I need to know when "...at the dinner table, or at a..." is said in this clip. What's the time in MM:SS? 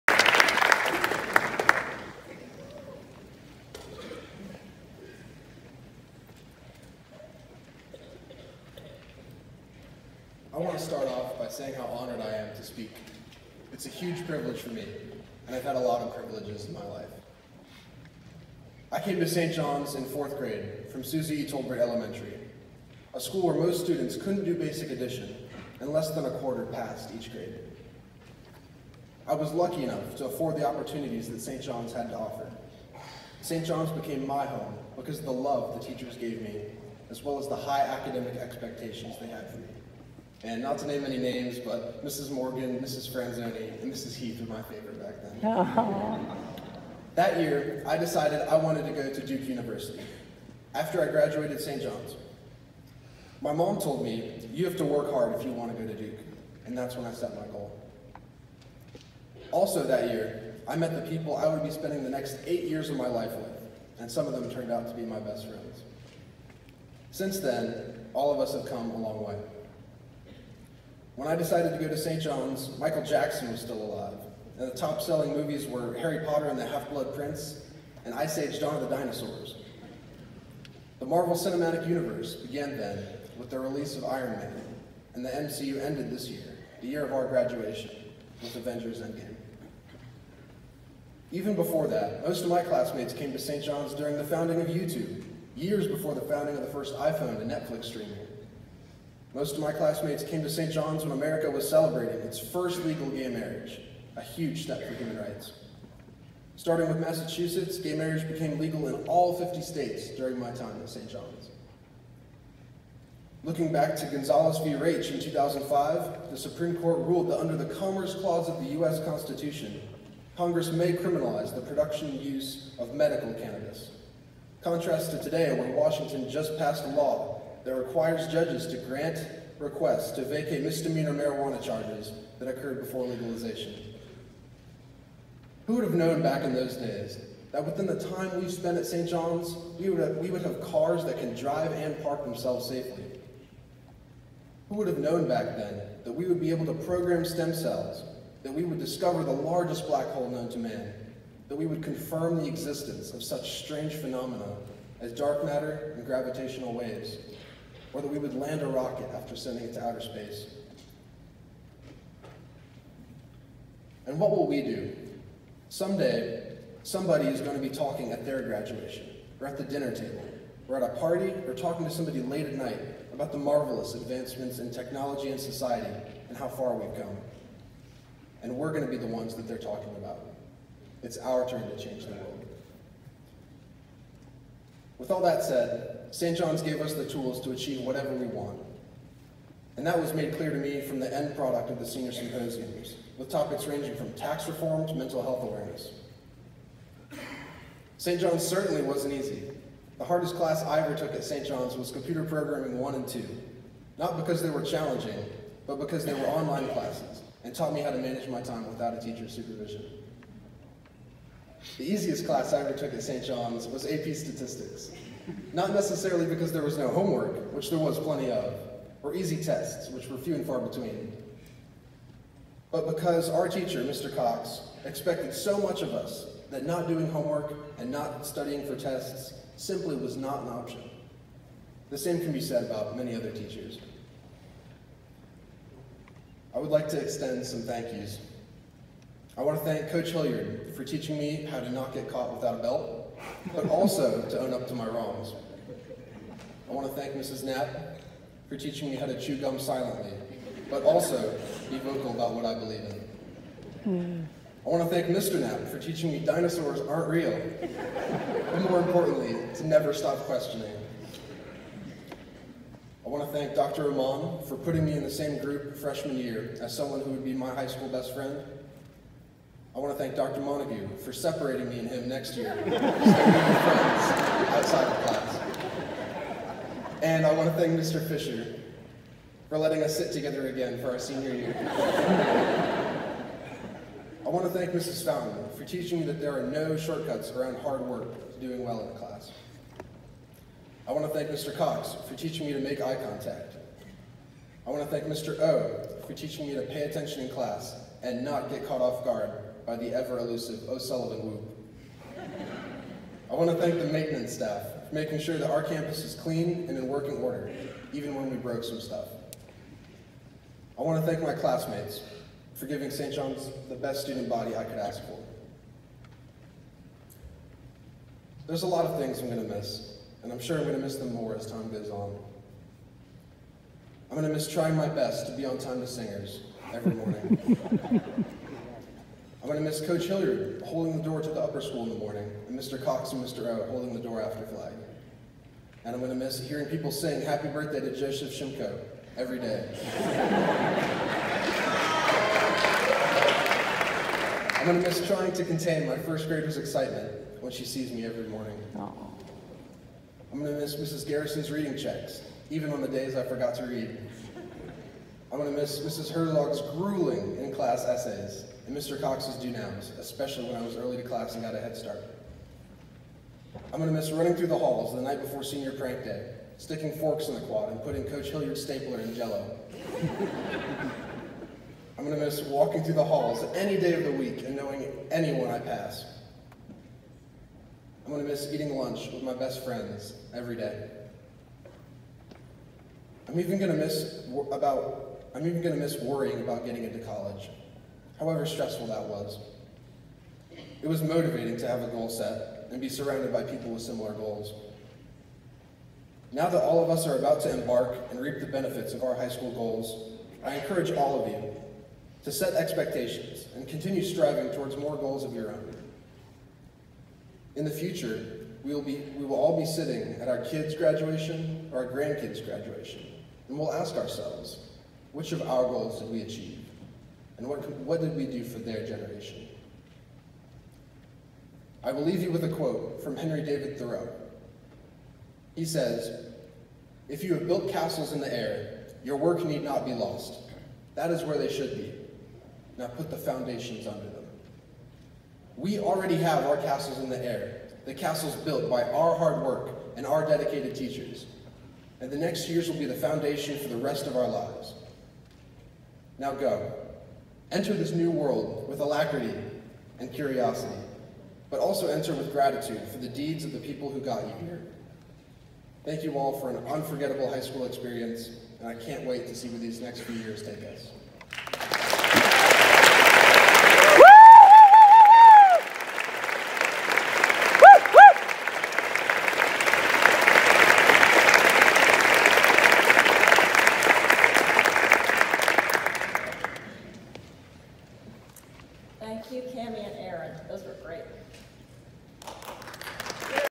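02:49.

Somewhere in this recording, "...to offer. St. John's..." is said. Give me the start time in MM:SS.
00:32.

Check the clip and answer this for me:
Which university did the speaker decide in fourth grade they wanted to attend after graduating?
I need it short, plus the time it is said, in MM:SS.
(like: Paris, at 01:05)
Duke University, at 00:49.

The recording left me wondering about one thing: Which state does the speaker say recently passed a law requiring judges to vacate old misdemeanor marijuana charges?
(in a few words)
Washington.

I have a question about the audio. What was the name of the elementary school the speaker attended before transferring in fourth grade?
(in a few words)
Susie E. Tolbert Elementary.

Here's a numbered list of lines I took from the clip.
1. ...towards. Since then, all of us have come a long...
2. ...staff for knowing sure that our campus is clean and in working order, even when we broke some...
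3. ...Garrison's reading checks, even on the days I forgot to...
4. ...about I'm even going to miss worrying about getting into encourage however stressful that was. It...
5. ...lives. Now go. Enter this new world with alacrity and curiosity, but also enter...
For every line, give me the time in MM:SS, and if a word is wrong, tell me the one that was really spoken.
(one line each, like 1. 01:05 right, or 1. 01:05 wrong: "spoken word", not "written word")
1. 01:05 wrong: "friends", not "towards"
2. 05:04 wrong: "making", not "knowing"
3. 05:51 right
4. 06:24 wrong: "college", not "encourage"
5. 07:24 right.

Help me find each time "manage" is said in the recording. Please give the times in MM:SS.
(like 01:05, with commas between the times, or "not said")
03:27.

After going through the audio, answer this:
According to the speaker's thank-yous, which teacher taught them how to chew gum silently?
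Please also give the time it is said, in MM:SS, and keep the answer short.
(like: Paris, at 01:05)
Mrs. Knapp, at 04:07.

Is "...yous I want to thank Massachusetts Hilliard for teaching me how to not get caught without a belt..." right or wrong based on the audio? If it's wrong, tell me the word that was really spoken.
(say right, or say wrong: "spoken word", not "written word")
wrong: "Coach", not "Massachusetts".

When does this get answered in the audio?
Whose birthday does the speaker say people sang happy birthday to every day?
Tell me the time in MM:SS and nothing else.
05:37.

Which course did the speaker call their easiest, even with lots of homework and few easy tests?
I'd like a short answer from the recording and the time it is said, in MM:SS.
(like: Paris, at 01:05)
AP Statistics, at 03:33.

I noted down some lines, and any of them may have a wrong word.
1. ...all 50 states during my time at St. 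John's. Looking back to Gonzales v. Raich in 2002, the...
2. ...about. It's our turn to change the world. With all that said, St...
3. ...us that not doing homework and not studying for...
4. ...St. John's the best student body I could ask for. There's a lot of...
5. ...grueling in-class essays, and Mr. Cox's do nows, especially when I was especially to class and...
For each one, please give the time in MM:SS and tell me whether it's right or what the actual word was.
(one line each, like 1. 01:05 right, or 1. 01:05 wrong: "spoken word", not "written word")
1. 01:49 wrong: "2005", not "2002"
2. 02:59 right
3. 03:45 right
4. 05:12 right
5. 05:56 wrong: "early", not "especially".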